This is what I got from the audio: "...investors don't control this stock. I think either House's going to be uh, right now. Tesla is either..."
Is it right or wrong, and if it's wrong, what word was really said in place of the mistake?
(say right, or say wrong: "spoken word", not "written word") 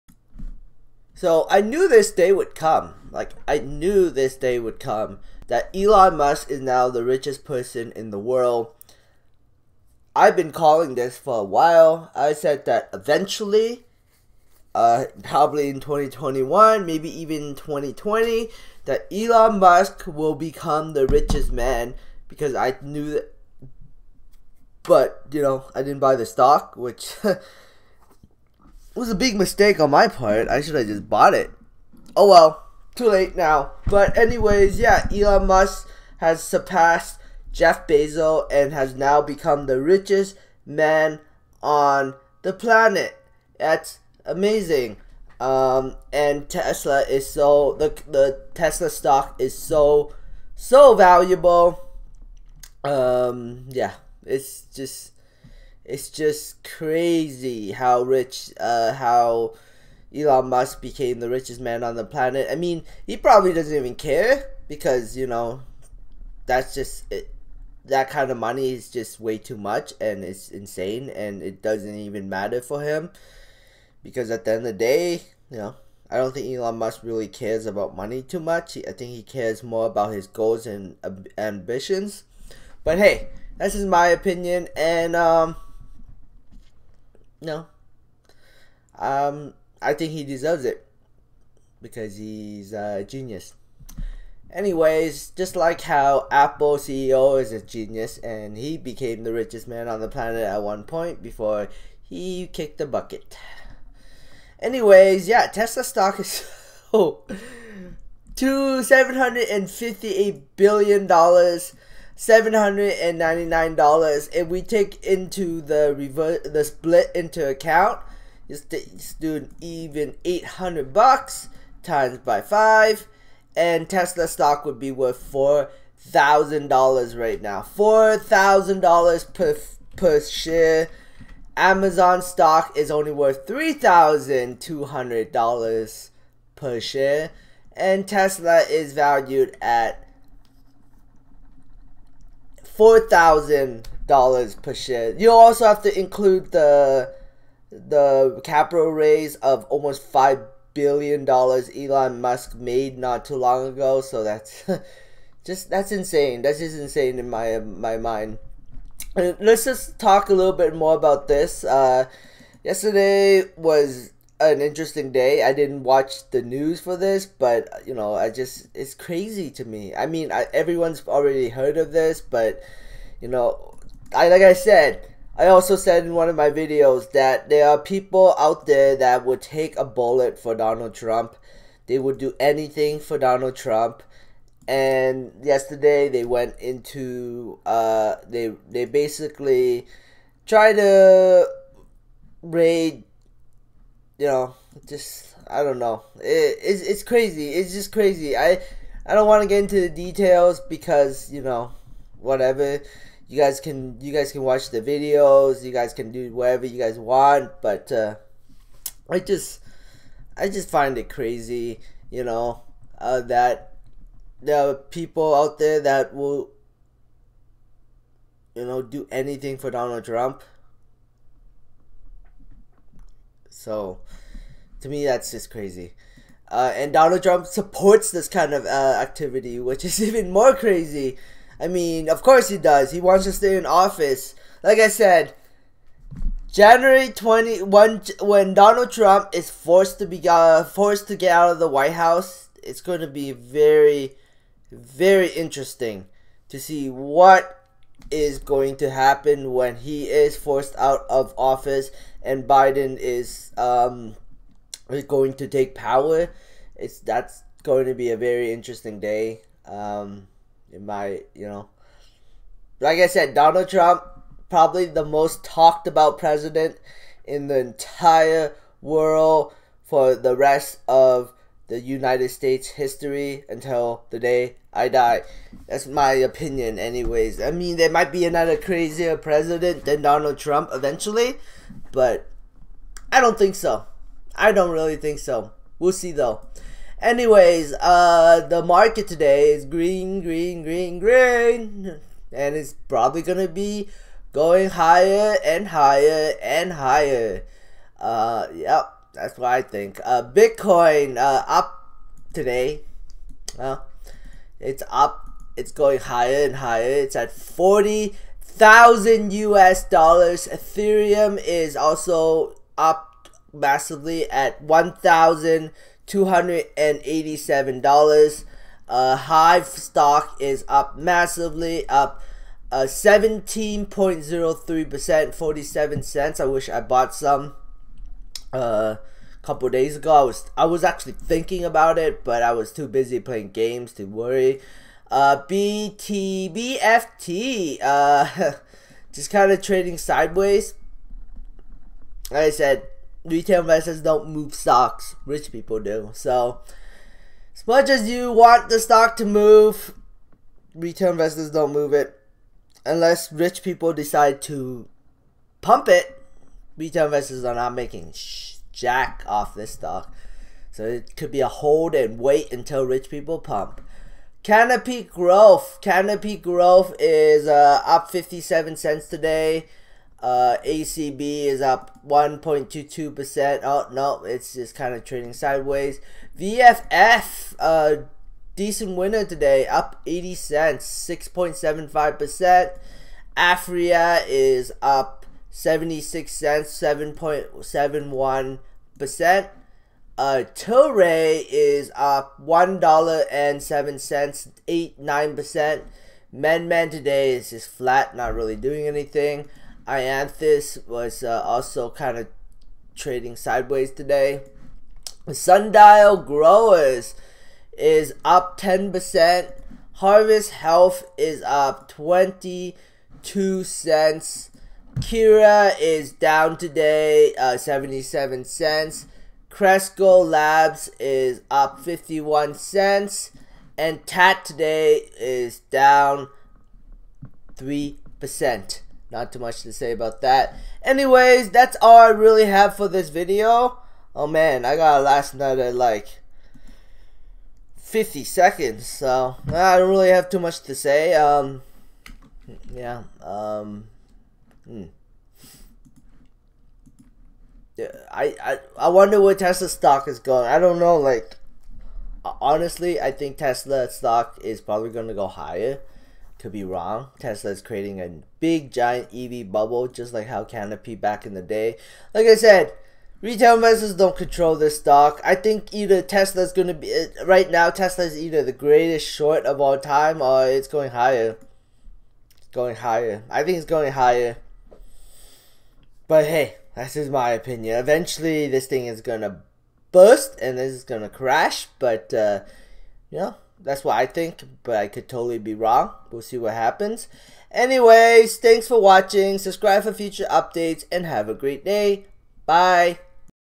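wrong: "Tesla", not "House".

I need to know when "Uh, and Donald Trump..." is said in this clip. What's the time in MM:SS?
03:46.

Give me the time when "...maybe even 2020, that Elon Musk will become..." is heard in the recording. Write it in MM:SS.
00:16.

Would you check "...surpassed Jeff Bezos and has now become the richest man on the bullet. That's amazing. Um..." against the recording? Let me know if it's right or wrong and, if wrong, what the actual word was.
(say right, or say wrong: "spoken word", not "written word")
wrong: "planet", not "bullet".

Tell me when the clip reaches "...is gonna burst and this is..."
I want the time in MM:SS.
07:58.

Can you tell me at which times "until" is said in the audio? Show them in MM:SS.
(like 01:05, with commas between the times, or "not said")
04:33, 06:02.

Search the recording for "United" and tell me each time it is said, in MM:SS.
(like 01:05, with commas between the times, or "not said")
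04:31.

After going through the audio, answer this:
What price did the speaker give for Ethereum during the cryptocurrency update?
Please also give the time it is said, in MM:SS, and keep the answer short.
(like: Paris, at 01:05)
$1,287, at 05:14.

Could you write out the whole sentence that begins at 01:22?
But hey, that's just my opinion and um no.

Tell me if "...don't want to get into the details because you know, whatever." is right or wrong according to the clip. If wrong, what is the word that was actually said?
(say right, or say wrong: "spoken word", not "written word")
right.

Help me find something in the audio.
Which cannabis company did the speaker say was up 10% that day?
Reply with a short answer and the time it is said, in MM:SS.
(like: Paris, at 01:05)
Sundial Growers, at 06:45.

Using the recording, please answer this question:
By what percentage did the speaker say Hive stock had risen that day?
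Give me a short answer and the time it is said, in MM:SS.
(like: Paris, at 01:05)
17.03%, at 05:22.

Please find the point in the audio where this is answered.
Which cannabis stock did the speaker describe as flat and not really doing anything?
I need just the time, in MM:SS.
06:36.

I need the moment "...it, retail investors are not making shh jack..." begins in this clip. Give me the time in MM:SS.
05:55.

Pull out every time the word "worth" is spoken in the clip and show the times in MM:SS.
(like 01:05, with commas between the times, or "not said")
02:04, 02:13.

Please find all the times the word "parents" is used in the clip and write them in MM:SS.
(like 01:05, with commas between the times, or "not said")
not said.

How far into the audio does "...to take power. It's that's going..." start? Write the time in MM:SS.
04:15.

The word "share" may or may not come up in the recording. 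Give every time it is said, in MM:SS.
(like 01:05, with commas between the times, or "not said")
02:10, 02:16, 02:24.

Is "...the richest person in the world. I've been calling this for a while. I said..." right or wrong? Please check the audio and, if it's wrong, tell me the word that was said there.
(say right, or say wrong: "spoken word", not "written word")
right.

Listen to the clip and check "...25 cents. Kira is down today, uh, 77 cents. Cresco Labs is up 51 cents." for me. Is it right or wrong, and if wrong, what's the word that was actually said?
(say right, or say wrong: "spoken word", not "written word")
wrong: "22", not "25".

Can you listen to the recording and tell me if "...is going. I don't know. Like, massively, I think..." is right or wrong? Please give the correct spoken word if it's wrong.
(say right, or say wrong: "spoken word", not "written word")
wrong: "honestly", not "massively".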